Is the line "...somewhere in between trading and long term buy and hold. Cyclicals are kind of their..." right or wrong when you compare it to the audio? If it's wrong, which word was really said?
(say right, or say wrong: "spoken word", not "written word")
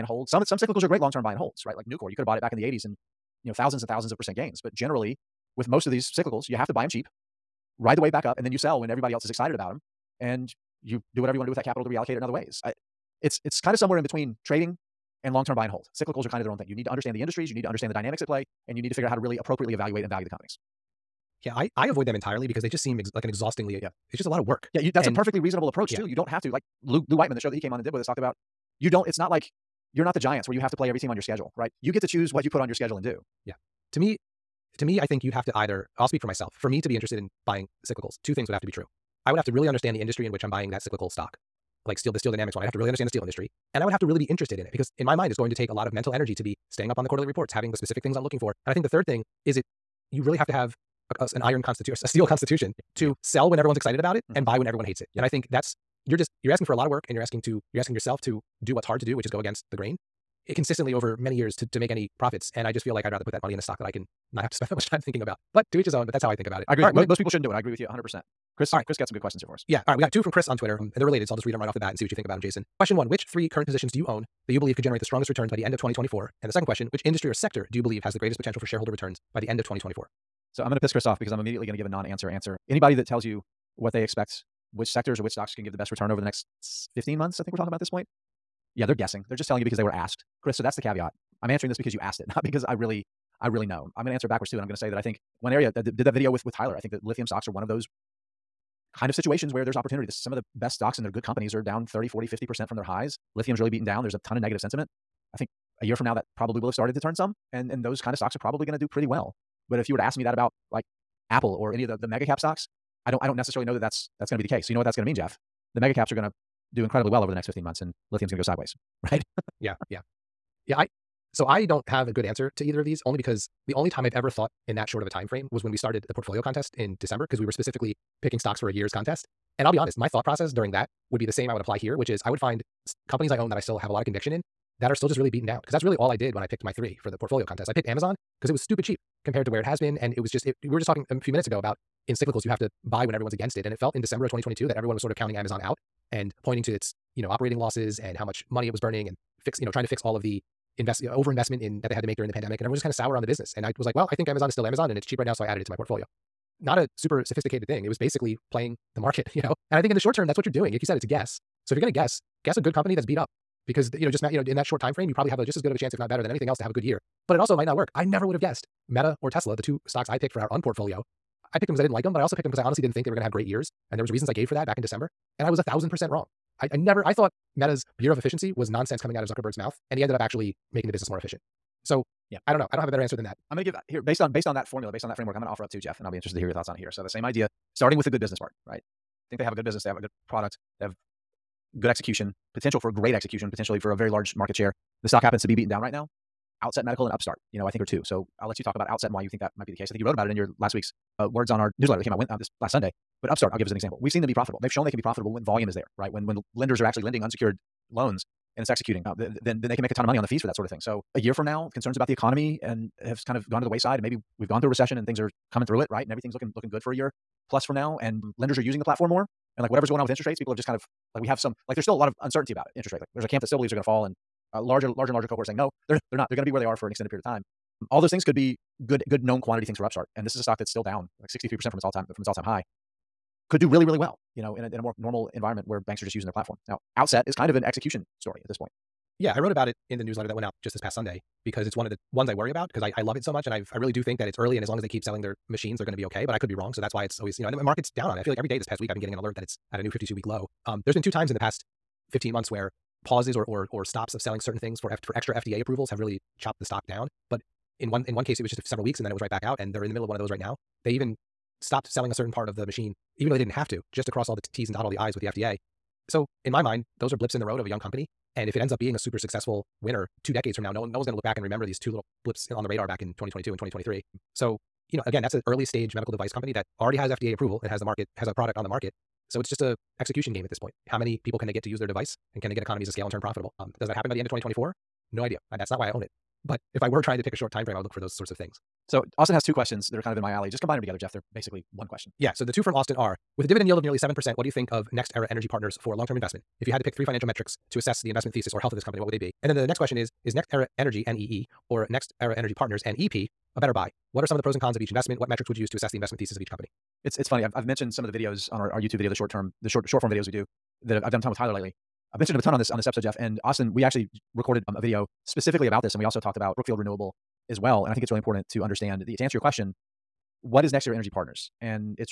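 right.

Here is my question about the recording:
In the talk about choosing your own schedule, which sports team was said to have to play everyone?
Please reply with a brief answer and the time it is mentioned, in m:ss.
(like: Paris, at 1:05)
the Giants, at 0:30.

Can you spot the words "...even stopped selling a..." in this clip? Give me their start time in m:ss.
4:20.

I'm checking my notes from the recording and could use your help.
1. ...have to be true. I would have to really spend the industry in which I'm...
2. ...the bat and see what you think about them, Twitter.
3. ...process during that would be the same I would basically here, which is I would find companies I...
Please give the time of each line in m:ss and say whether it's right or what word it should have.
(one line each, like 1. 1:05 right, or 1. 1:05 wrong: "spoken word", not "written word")
1. 0:38 wrong: "understand", not "spend"
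2. 1:11 wrong: "Jason", not "Twitter"
3. 2:10 wrong: "apply", not "basically".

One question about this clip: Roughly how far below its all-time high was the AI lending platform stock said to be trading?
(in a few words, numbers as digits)
63 percent.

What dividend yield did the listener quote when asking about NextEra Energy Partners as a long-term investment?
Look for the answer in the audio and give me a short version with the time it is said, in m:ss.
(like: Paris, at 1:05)
nearly 7%, at 4:53.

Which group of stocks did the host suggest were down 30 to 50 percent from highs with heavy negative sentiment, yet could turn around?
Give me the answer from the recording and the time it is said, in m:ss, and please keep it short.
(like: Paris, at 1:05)
lithium stocks, at 1:37.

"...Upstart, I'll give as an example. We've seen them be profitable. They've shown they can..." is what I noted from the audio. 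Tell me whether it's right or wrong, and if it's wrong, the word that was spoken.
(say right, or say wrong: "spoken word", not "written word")
right.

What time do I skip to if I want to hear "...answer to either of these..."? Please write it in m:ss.
2:02.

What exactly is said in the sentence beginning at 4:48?
So Austin has two questions that are kind of in my alley.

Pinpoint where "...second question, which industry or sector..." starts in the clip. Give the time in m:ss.
1:16.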